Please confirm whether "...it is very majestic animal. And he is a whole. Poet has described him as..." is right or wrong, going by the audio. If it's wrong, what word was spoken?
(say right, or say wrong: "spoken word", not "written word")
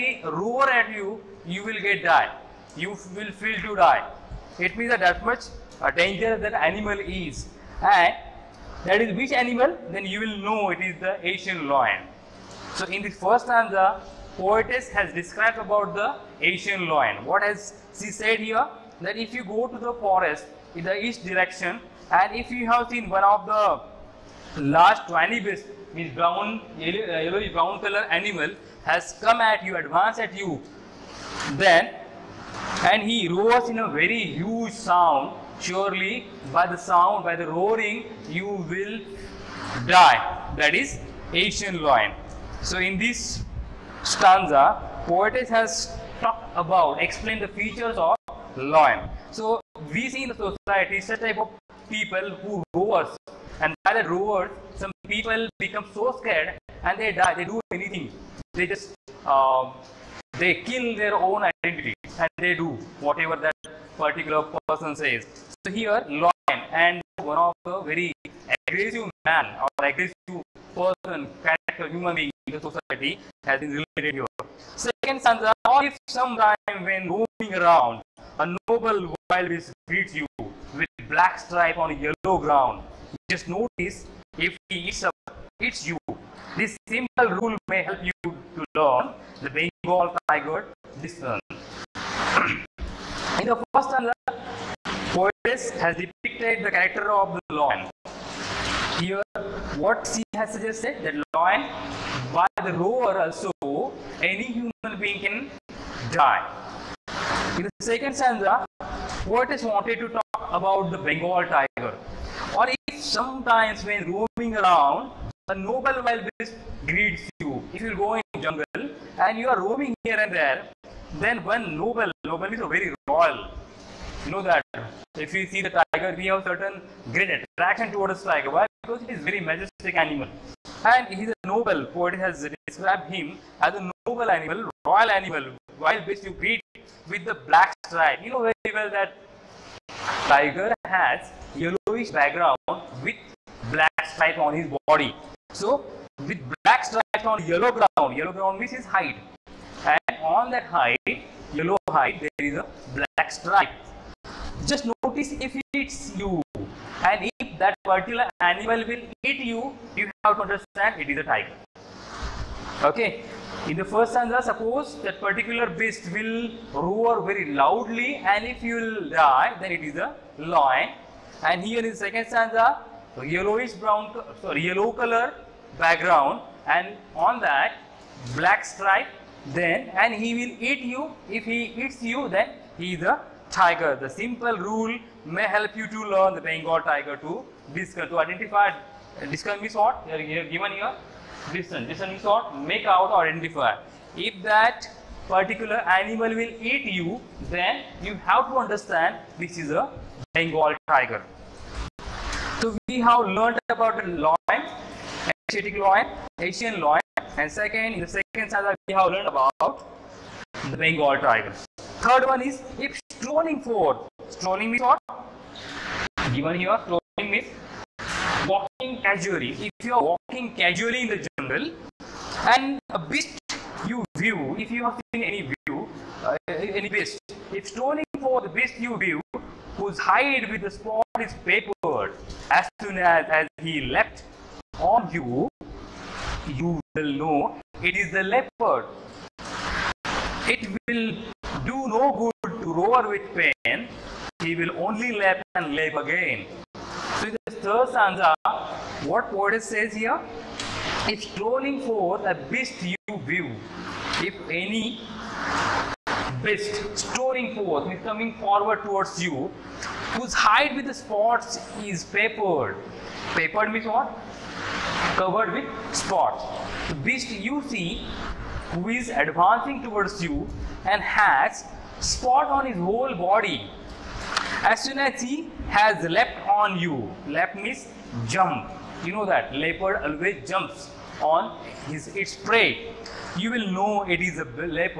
wrong: "noble", not "whole".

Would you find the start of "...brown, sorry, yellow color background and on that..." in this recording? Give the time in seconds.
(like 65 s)
173 s.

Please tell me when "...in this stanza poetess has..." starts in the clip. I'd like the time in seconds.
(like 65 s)
42 s.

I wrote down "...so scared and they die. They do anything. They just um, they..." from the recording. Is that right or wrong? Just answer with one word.
right.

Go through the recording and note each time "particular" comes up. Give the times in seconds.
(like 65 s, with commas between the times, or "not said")
63 s, 157 s, 165 s, 195 s.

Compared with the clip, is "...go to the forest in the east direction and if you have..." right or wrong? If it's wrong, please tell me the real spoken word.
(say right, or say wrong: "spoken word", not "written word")
right.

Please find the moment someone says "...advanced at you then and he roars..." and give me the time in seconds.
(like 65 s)
29 s.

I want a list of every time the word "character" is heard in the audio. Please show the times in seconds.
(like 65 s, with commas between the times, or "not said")
71 s, 96 s.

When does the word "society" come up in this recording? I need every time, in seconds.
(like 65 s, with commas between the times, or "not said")
50 s, 72 s.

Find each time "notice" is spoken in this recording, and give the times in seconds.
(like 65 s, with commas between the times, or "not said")
83 s, 155 s.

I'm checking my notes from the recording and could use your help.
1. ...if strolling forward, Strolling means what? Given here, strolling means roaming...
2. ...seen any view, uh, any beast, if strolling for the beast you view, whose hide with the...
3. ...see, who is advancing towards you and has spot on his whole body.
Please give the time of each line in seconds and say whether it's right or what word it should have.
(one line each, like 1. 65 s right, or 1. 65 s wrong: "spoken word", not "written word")
1. 212 s wrong: "walking", not "roaming"
2. 225 s right
3. 267 s right.